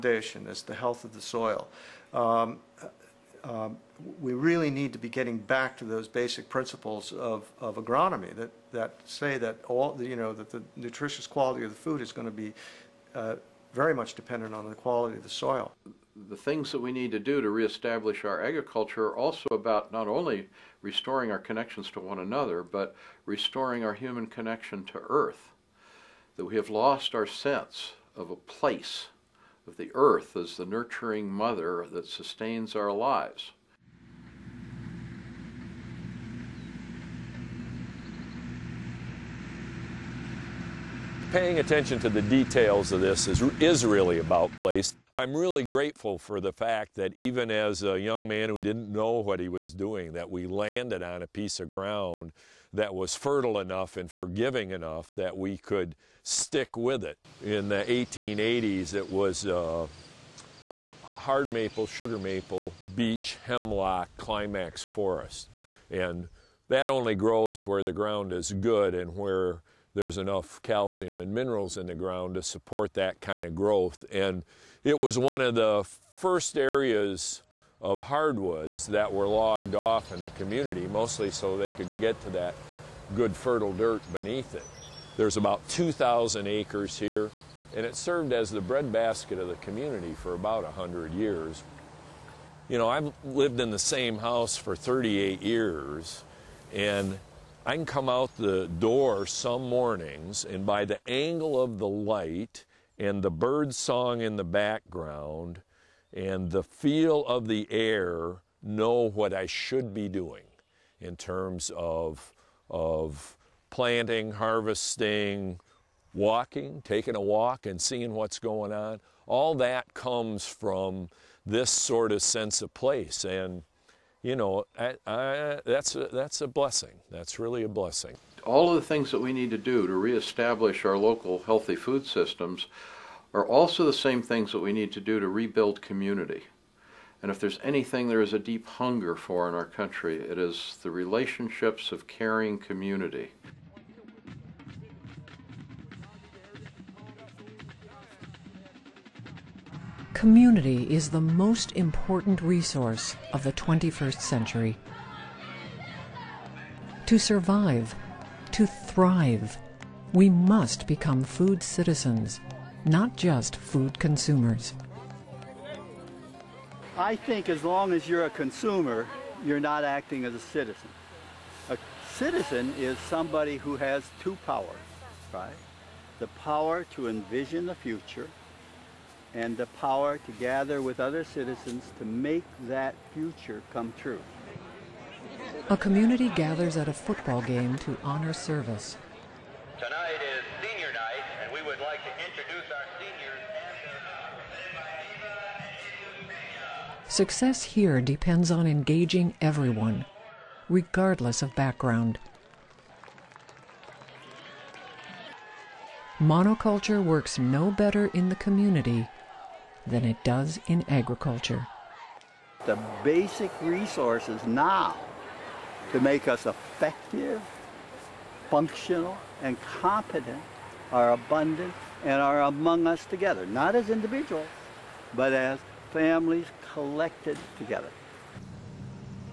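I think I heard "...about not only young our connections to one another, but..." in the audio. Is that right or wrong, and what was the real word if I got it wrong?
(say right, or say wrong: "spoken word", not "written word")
wrong: "restoring", not "young".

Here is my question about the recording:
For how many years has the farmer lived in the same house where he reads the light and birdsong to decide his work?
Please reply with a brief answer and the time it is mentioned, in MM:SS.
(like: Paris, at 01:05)
38, at 01:34.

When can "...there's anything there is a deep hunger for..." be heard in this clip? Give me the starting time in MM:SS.
02:17.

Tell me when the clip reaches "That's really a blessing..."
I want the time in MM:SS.
02:07.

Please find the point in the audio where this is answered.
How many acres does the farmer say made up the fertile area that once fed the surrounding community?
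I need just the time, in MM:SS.
01:25.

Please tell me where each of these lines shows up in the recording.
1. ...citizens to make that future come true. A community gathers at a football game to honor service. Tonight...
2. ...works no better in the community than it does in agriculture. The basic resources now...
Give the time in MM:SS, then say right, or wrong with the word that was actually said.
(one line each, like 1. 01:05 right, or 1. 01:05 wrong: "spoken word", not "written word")
1. 03:01 right
2. 03:27 right.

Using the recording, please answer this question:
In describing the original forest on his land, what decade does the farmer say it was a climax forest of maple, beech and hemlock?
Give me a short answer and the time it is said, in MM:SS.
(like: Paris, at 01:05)
1880s, at 00:57.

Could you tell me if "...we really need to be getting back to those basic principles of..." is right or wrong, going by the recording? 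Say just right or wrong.
right.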